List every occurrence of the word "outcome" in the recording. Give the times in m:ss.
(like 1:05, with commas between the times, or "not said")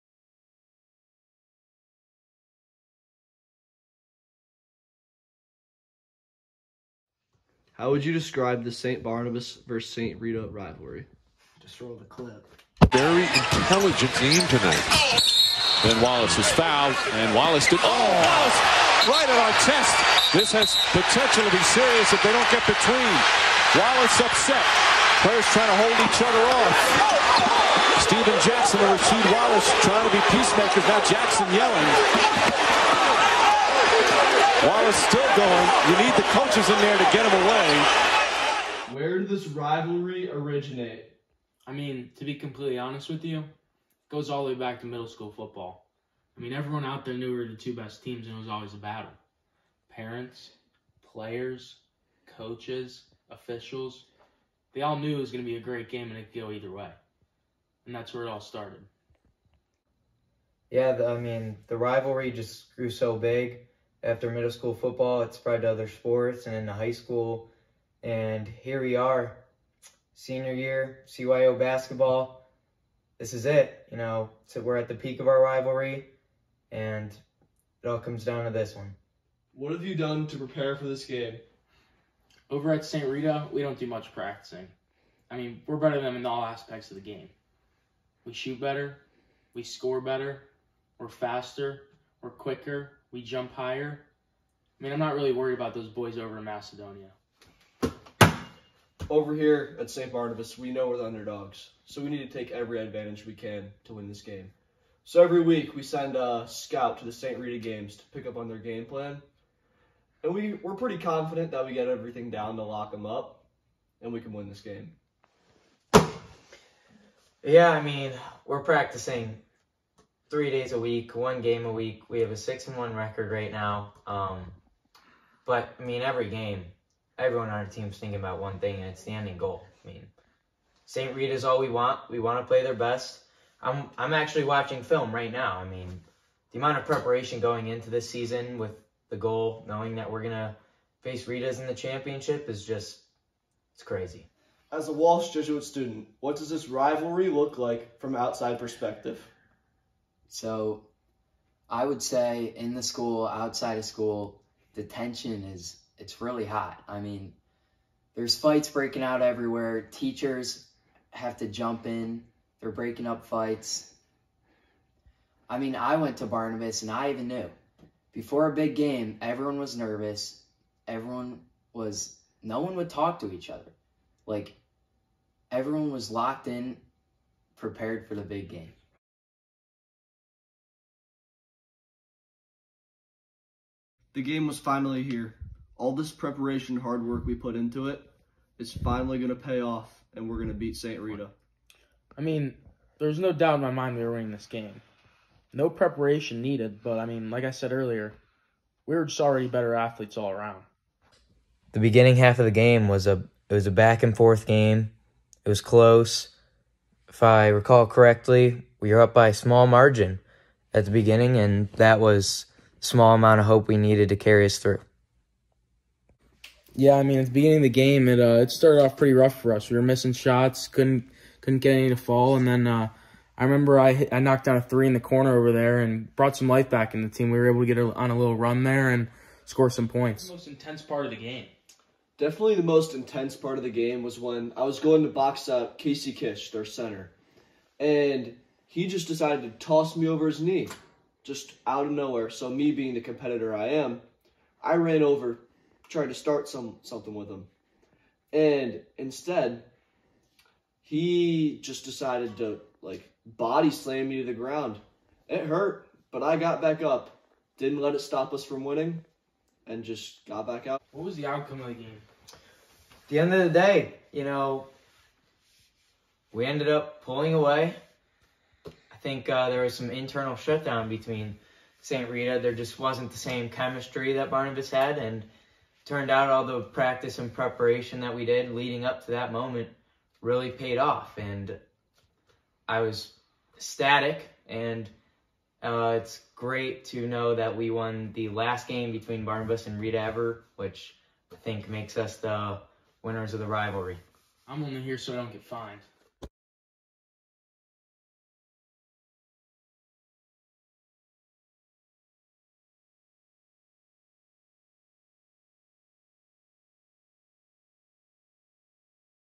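4:21.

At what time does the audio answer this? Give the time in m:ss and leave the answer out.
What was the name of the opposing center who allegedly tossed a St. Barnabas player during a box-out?
3:55.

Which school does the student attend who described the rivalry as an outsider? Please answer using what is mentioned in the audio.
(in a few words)
Walsh Jesuit.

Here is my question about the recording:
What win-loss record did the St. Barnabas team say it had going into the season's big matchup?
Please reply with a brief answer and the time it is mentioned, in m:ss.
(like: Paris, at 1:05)
6 and 1, at 2:02.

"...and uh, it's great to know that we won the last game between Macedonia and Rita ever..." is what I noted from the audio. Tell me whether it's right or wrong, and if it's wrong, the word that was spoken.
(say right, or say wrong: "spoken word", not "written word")
wrong: "Barnabas", not "Macedonia".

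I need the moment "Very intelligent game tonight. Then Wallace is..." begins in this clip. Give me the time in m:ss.
0:12.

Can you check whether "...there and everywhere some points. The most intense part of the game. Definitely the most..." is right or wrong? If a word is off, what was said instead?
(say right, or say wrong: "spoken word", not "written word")
wrong: "score", not "everywhere".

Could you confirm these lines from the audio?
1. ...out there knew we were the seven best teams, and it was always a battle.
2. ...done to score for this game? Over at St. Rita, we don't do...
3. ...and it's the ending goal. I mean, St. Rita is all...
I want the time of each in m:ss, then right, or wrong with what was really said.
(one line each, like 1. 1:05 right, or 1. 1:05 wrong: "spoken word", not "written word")
1. 0:46 wrong: "two", not "seven"
2. 1:19 wrong: "prepare", not "score"
3. 2:08 right.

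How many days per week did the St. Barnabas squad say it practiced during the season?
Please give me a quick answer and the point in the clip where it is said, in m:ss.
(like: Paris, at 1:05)
3, at 2:00.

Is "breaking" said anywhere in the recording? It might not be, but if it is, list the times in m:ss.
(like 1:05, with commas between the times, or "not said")
2:38, 2:42.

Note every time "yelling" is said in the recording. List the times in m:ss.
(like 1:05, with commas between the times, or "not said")
0:31.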